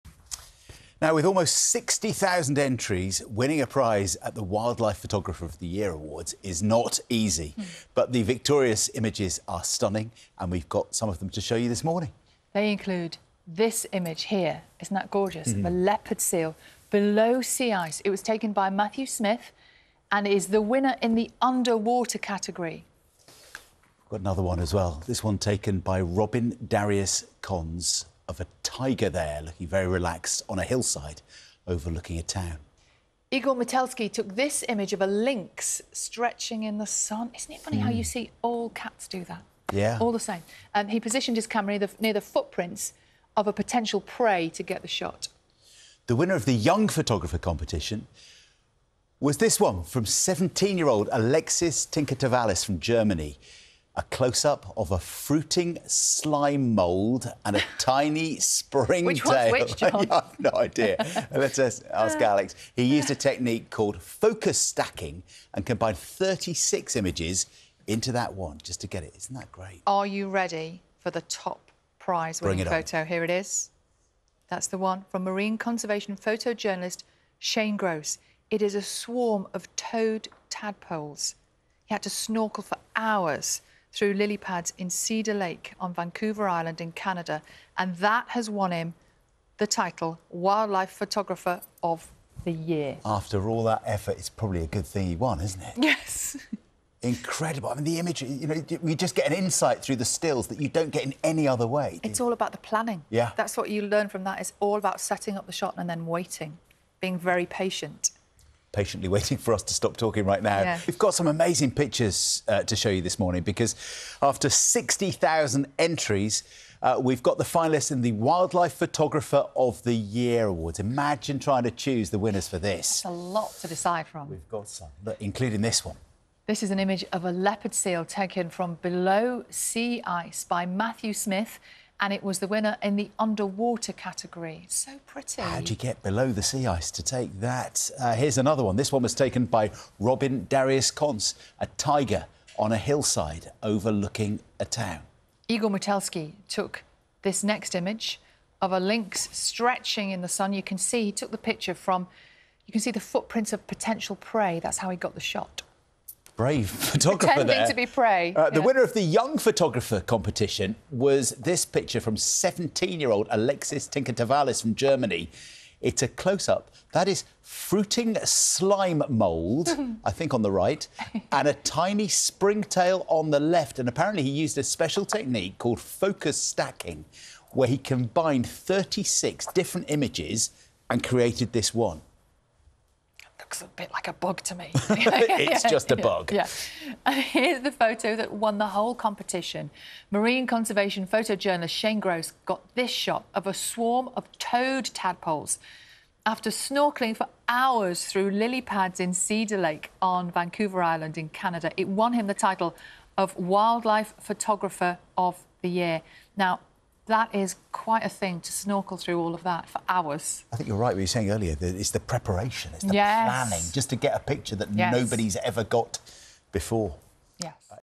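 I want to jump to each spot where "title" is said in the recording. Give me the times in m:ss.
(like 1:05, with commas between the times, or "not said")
1:29, 3:22.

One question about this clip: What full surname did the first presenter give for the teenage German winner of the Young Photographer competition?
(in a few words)
Tinker Tsavalas.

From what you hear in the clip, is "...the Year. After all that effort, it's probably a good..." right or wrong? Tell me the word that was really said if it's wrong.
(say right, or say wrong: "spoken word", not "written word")
right.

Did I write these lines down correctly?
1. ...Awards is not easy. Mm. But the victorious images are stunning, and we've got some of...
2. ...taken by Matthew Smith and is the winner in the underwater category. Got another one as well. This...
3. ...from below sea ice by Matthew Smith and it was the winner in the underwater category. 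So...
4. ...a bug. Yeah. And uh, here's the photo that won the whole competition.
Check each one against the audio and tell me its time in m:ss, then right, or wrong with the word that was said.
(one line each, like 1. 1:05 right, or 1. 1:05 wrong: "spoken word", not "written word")
1. 0:05 right
2. 0:18 right
3. 2:08 right
4. 3:05 right.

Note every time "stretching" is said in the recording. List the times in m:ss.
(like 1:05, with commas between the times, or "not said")
0:35, 2:29.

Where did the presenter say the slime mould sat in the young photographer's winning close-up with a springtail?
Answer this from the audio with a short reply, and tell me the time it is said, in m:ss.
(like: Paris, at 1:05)
On the right, at 2:50.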